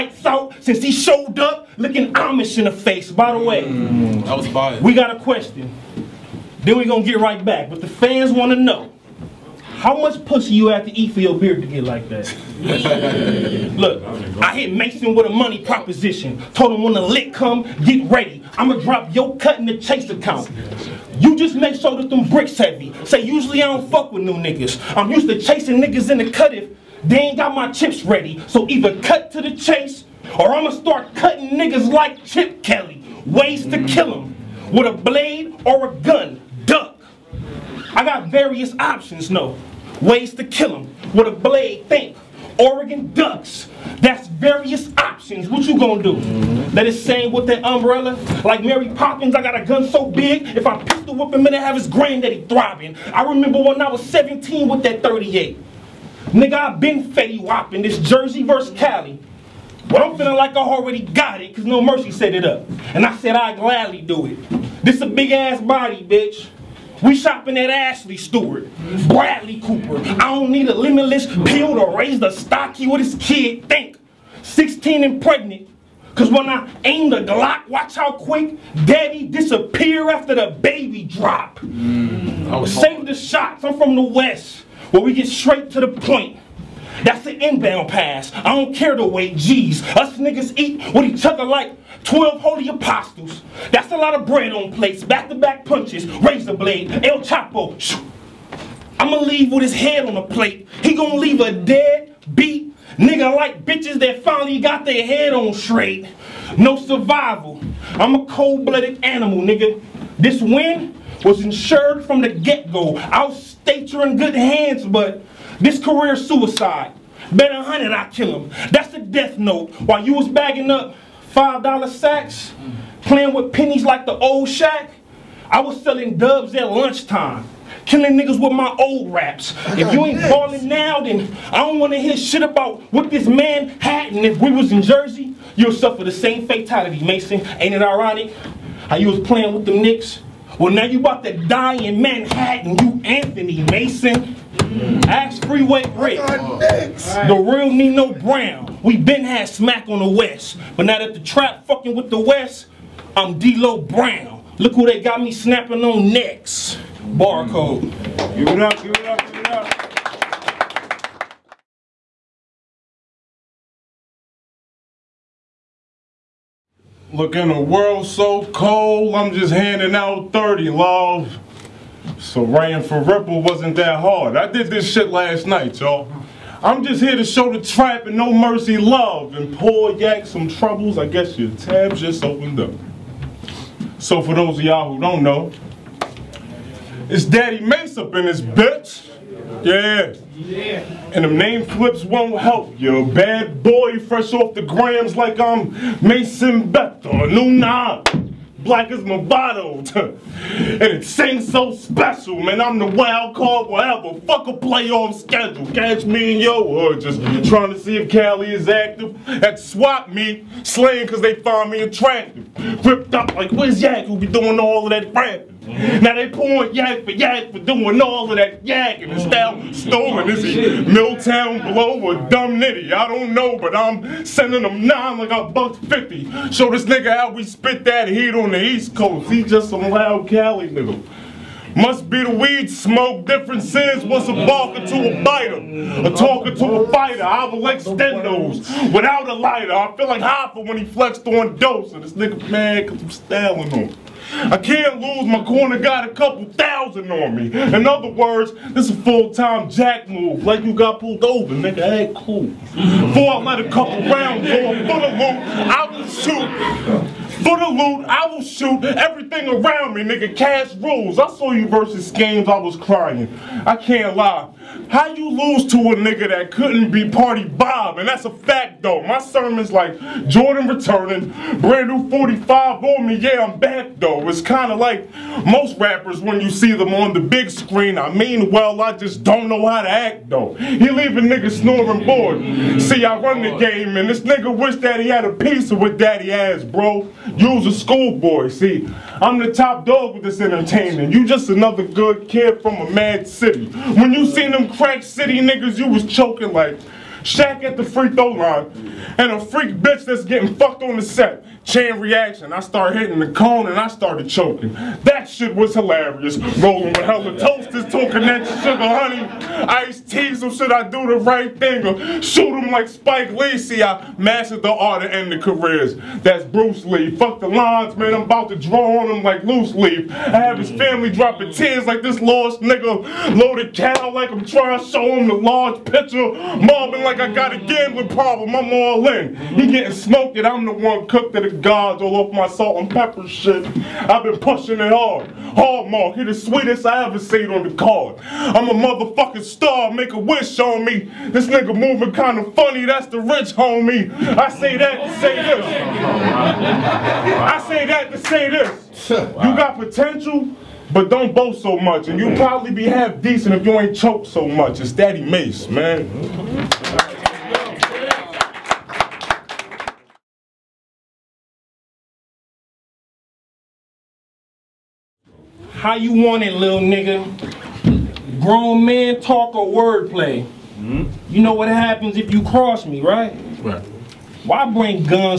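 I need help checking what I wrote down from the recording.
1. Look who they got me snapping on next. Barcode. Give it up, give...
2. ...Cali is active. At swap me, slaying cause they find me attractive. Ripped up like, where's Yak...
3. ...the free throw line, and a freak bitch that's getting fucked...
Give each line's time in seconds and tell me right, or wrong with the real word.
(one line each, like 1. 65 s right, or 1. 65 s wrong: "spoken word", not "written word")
1. 154 s right
2. 208 s right
3. 297 s right.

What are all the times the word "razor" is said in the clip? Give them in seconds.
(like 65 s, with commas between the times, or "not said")
96 s.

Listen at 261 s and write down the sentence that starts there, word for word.
I saw you versus games, I was crying.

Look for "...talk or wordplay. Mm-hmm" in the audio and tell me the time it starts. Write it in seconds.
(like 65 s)
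369 s.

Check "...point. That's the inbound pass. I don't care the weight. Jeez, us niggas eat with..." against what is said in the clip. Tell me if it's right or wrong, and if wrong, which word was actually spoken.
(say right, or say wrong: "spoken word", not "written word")
right.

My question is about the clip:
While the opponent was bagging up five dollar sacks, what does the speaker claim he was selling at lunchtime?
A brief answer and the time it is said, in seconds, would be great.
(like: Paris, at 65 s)
dubs, at 126 s.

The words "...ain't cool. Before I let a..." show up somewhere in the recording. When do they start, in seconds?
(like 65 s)
251 s.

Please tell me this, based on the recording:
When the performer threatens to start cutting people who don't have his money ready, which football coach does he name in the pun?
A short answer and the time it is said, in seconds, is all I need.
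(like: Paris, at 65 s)
Chip Kelly, at 32 s.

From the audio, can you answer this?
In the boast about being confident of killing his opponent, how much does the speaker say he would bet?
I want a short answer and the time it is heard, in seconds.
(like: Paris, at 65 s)
100, at 117 s.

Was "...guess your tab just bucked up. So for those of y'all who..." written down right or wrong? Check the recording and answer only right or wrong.
wrong.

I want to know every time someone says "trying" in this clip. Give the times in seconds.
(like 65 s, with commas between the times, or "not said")
207 s, 324 s.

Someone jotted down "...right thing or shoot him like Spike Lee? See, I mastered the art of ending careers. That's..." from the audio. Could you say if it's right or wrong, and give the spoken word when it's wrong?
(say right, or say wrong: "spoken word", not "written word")
right.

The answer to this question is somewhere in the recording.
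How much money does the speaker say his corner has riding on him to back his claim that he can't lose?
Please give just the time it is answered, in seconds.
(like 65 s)
246 s.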